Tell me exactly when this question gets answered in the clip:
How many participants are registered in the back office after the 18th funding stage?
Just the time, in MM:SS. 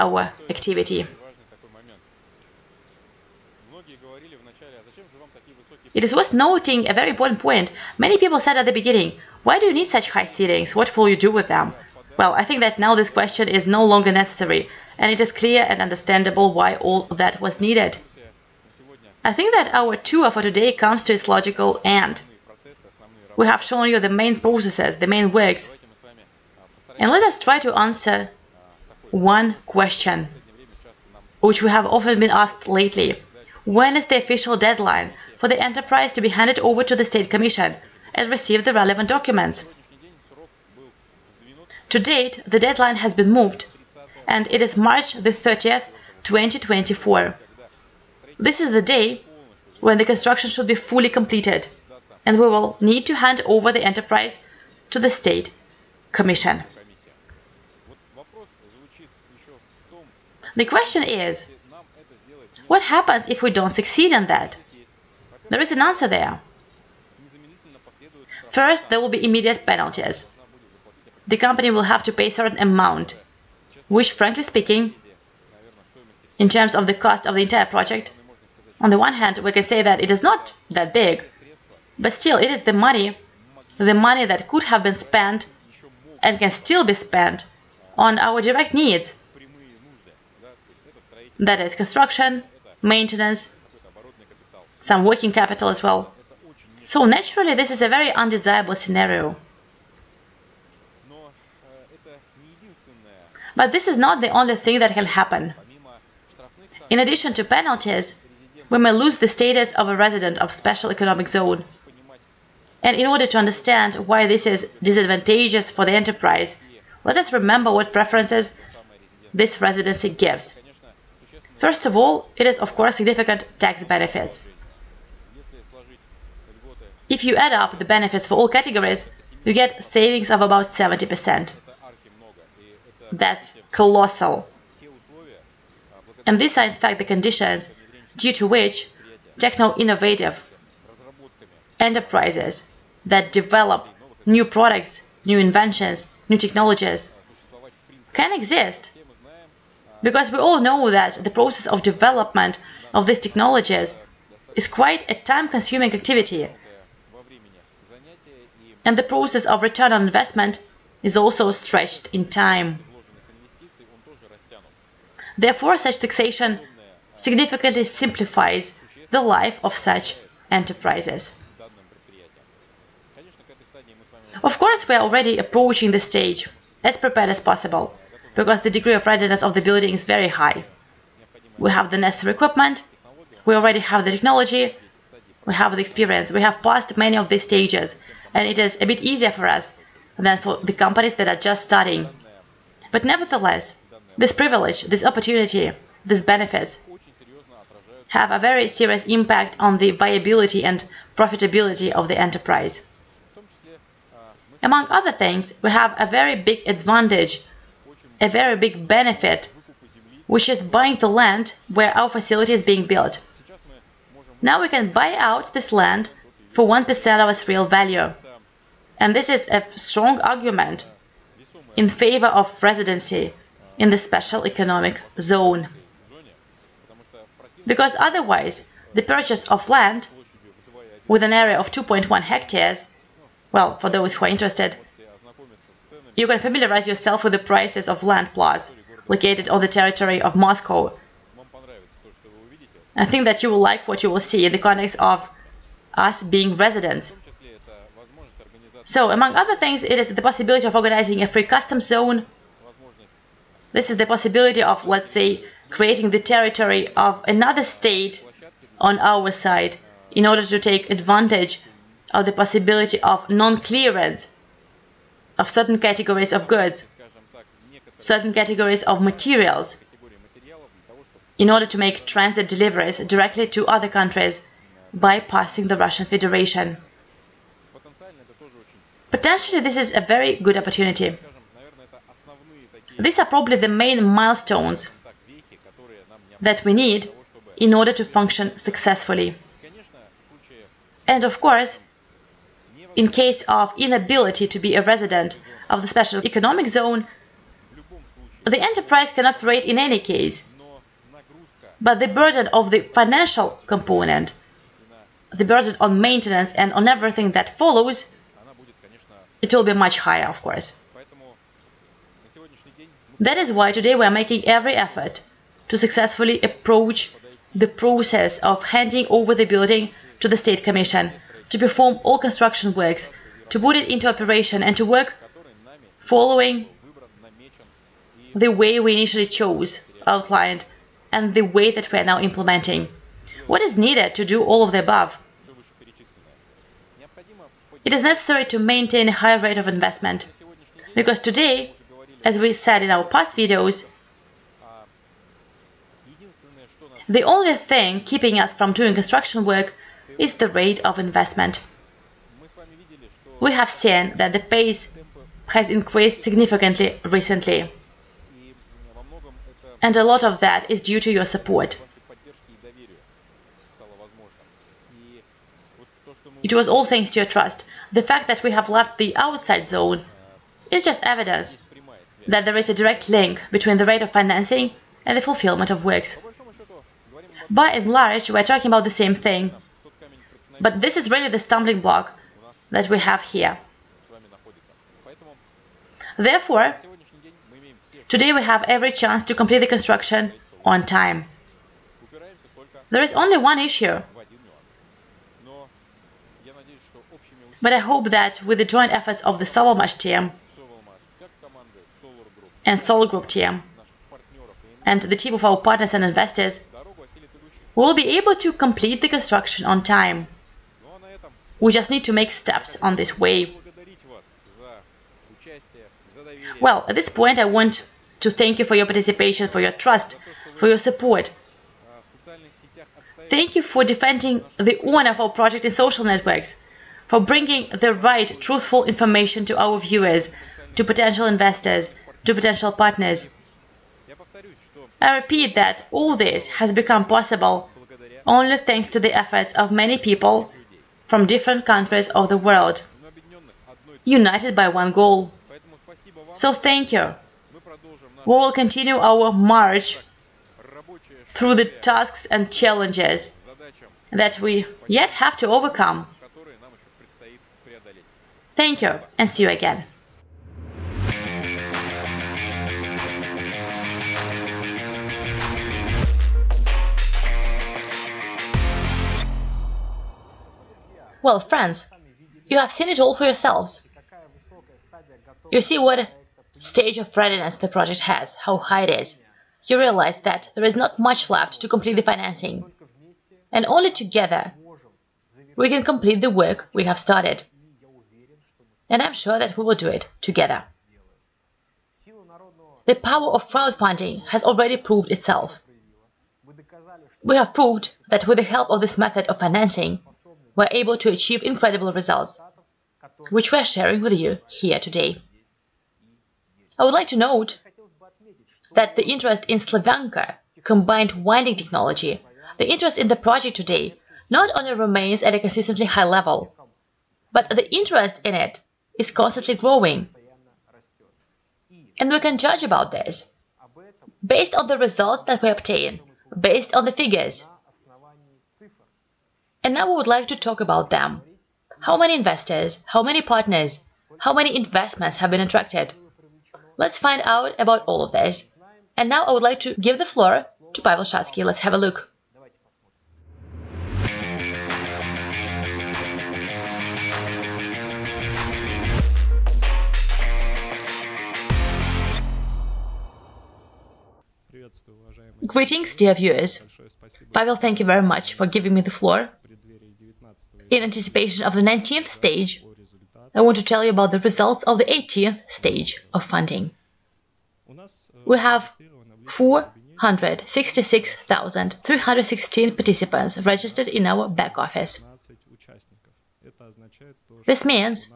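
09:29.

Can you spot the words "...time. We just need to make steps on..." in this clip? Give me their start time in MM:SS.
06:49.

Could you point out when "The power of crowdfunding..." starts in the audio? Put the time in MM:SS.
08:12.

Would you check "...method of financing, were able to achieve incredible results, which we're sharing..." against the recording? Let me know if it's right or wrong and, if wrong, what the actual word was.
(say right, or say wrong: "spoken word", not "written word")
right.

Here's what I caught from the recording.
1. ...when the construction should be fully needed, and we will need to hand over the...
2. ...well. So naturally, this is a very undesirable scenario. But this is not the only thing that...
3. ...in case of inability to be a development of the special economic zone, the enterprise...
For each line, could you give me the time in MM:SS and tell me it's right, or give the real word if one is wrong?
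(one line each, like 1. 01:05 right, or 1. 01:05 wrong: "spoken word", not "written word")
1. 00:49 wrong: "completed", not "needed"
2. 01:35 right
3. 04:52 wrong: "resident", not "development".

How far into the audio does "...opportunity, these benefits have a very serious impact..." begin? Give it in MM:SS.
03:15.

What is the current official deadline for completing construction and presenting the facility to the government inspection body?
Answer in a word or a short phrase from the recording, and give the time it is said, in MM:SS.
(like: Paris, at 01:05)
March 30, 2024, at 00:44.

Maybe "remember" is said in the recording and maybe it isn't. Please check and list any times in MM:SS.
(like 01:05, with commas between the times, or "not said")
01:57.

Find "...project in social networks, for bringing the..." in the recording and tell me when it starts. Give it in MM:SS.
07:05.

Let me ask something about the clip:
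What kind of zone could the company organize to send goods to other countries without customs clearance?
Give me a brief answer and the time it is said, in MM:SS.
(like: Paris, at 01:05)
Free custom zone, at 04:11.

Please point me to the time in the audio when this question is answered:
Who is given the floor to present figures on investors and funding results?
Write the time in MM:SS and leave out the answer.
09:00.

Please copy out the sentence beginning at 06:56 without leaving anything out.
Well, at this point I want to thank you for your participation, for your trust, for your support.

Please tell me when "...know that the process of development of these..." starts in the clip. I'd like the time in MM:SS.
02:30.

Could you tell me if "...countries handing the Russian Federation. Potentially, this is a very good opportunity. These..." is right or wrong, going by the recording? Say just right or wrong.
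wrong.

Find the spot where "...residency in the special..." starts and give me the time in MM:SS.
03:42.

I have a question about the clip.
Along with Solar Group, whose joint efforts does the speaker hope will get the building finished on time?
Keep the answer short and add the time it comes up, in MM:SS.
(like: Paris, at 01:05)
Sovelmash, at 06:39.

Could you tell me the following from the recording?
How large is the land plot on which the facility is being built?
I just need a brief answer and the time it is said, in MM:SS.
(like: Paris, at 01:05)
2.1 hectares, at 03:51.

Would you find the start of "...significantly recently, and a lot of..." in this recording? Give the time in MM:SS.
05:56.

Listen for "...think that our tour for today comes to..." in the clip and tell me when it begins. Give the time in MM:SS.
00:19.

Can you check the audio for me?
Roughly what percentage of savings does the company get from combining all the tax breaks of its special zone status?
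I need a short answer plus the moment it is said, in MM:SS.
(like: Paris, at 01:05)
70%, at 02:10.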